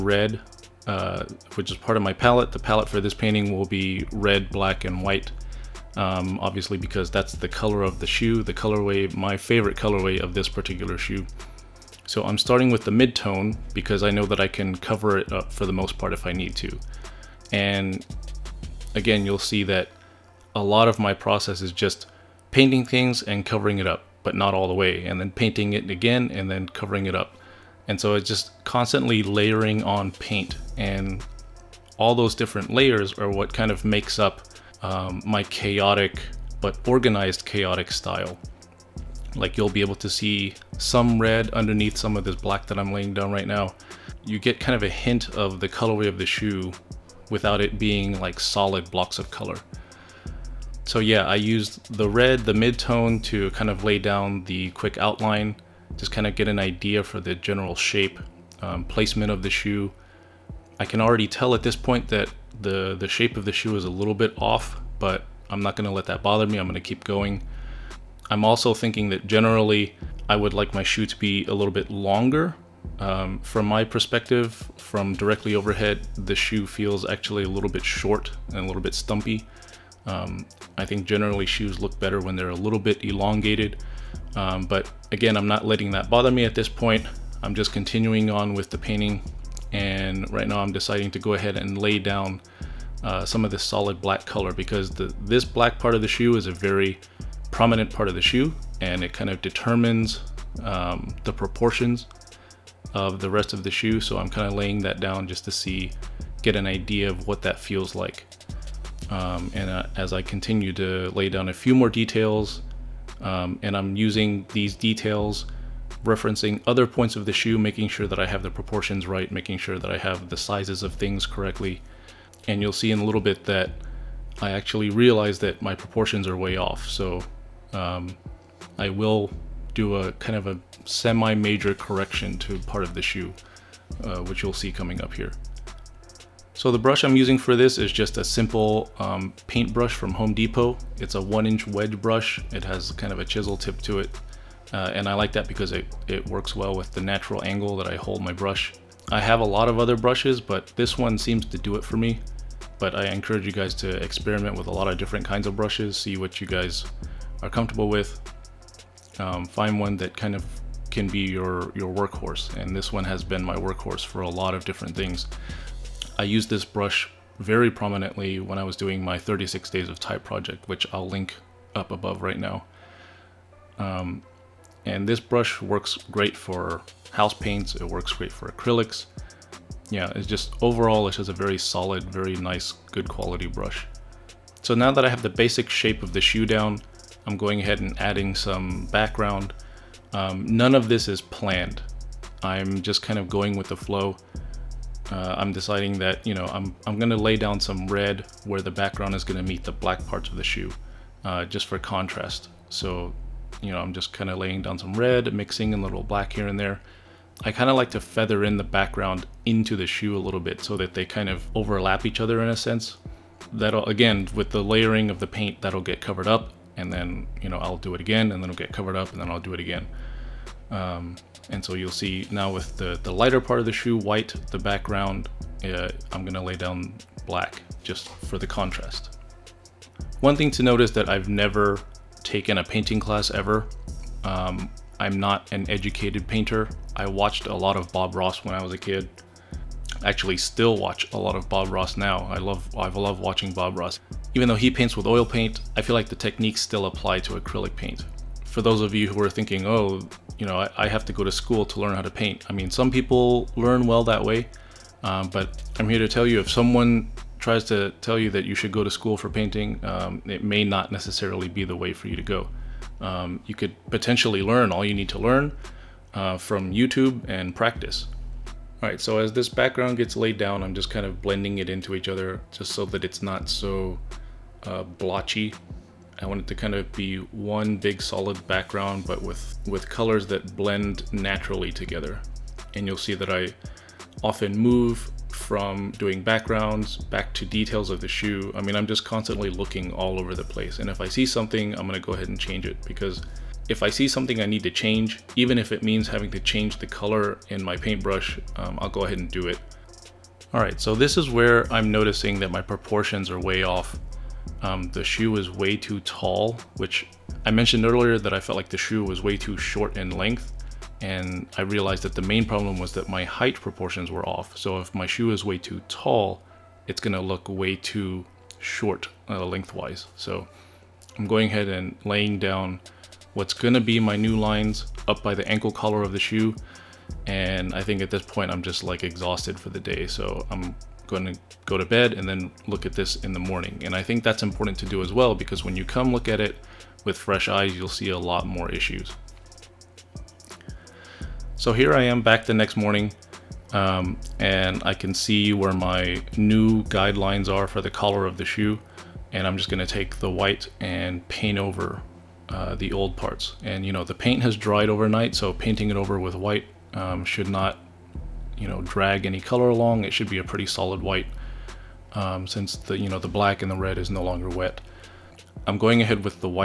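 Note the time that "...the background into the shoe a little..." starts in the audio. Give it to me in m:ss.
3:28.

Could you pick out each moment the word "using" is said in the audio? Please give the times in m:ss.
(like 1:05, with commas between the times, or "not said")
1:53, 2:17.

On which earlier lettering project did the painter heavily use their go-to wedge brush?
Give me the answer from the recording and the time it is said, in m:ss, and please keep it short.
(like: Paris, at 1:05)
36 Days of Type, at 2:49.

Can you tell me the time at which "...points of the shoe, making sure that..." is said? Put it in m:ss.
1:56.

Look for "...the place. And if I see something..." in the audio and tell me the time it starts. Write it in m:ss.
4:50.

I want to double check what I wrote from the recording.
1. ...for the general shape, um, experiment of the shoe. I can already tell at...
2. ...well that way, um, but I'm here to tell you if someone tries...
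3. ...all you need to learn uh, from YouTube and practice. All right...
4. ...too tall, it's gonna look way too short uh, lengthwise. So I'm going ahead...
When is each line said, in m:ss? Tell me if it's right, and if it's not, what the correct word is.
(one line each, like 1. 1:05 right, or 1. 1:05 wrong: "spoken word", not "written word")
1. 0:57 wrong: "placement", not "experiment"
2. 4:13 right
3. 4:24 right
4. 5:15 right.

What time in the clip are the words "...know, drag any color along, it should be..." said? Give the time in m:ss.
5:58.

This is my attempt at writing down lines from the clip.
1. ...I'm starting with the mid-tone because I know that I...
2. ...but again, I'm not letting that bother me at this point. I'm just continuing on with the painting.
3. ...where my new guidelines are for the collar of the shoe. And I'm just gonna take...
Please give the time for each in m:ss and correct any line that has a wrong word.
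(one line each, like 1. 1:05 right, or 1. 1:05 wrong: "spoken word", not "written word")
1. 0:12 right
2. 1:24 right
3. 5:45 right.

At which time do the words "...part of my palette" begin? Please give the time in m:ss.
0:01.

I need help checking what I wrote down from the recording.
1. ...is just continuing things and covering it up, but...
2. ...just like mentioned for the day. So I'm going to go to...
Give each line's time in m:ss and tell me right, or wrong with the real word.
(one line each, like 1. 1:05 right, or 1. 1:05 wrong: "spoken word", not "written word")
1. 0:21 wrong: "painting", not "continuing"
2. 5:28 wrong: "exhausted", not "mentioned".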